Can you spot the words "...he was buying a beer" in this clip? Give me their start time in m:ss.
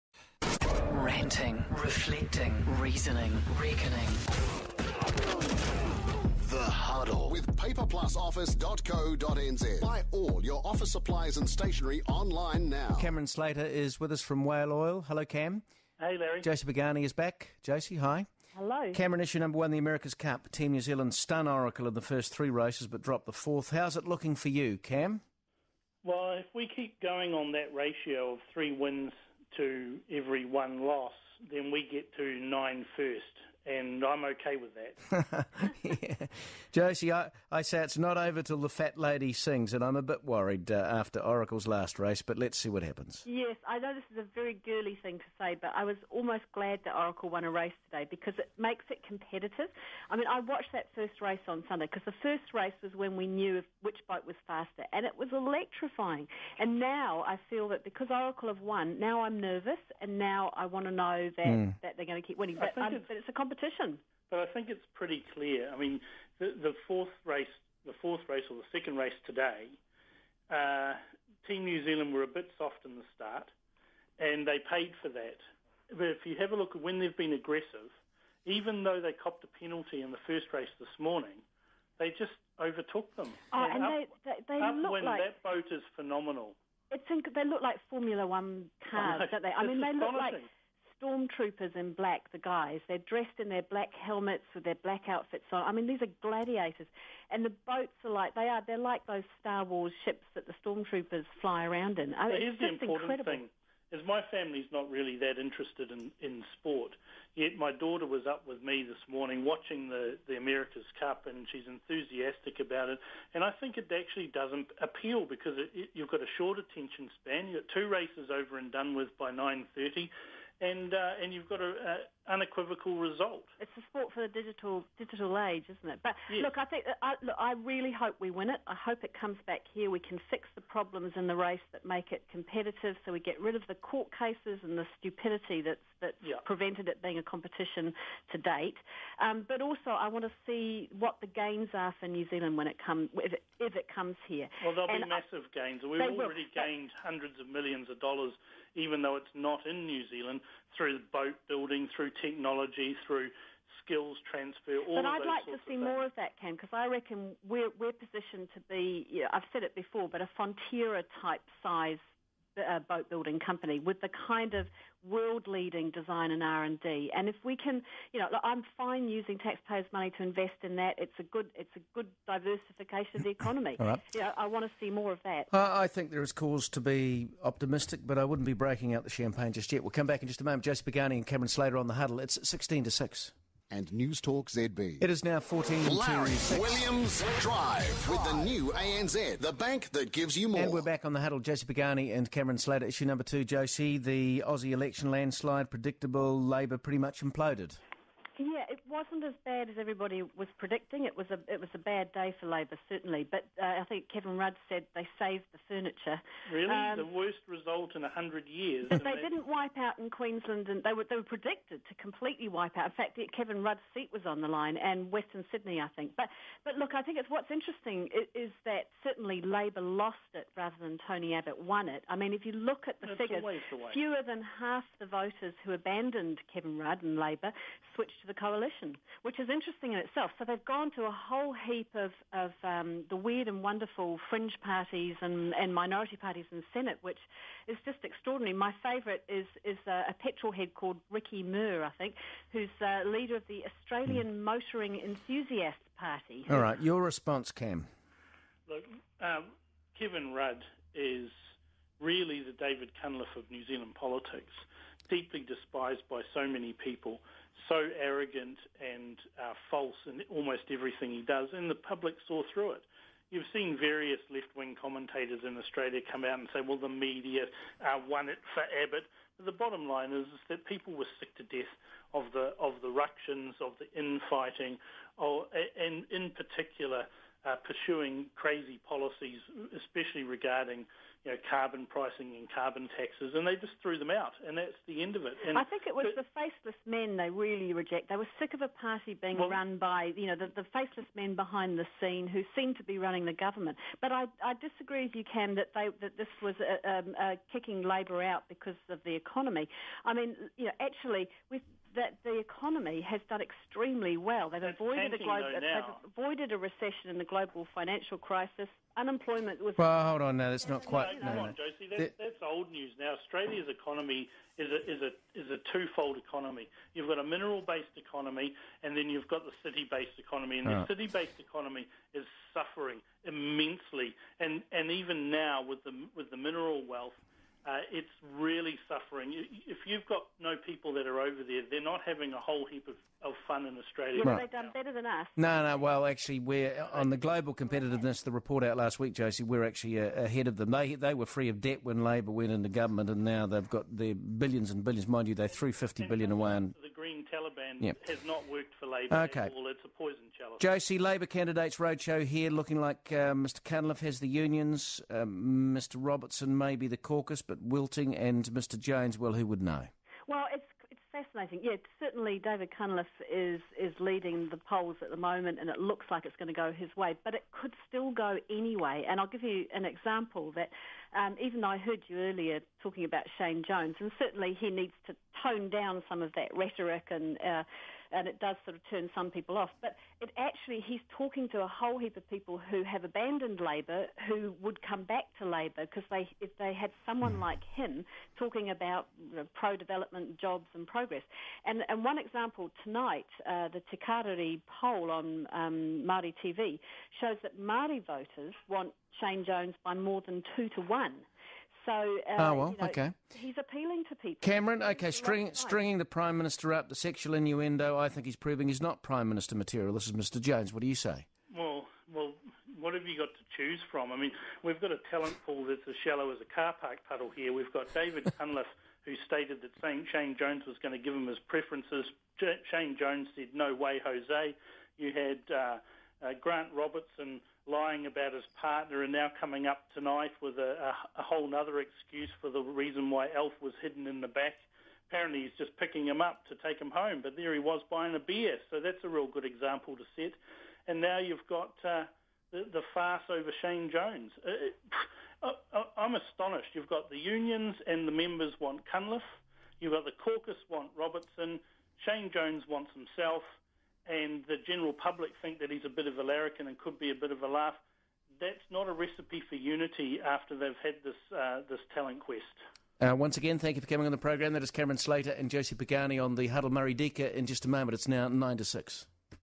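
7:17.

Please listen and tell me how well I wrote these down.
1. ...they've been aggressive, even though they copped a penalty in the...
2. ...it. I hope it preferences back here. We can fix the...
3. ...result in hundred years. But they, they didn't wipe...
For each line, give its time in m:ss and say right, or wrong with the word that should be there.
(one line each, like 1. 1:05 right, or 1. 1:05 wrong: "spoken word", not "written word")
1. 1:16 right
2. 2:08 wrong: "comes", not "preferences"
3. 3:27 right.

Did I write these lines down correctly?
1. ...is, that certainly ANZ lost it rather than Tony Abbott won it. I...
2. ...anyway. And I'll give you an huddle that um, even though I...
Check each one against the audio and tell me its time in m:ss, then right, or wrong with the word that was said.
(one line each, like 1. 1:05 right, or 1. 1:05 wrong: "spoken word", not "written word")
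1. 3:38 wrong: "Labor", not "ANZ"
2. 6:08 wrong: "example", not "huddle".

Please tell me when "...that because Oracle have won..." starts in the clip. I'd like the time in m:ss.
0:57.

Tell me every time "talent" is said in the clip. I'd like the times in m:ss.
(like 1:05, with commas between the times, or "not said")
6:55, 7:41.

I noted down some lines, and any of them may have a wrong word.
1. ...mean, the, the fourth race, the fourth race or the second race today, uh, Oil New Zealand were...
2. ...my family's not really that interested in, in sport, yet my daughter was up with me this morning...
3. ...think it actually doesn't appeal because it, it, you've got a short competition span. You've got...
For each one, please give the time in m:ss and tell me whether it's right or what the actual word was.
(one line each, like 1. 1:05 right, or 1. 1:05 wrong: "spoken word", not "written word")
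1. 1:05 wrong: "Team", not "Oil"
2. 1:44 right
3. 1:53 wrong: "attention", not "competition".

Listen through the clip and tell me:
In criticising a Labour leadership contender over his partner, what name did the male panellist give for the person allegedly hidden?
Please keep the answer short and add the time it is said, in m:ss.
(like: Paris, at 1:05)
Alf, at 7:13.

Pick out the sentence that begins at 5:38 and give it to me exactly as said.
The report out last week, Josie, we're actually uh, ahead of them.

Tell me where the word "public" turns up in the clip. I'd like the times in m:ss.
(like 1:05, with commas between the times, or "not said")
4:21, 7:34.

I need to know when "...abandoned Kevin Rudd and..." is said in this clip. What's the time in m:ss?
3:45.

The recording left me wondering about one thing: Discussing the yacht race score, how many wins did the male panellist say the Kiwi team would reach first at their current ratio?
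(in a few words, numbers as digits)
9.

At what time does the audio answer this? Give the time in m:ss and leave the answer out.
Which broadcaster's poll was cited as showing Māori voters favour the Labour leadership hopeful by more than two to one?
6:33.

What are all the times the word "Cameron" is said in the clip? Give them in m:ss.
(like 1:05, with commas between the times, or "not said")
0:13, 0:18, 3:01, 3:12, 6:44, 7:44.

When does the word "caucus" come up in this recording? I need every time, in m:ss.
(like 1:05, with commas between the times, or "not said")
5:56, 7:30.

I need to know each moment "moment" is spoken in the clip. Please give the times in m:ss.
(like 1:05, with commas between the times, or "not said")
3:00, 6:05, 7:47.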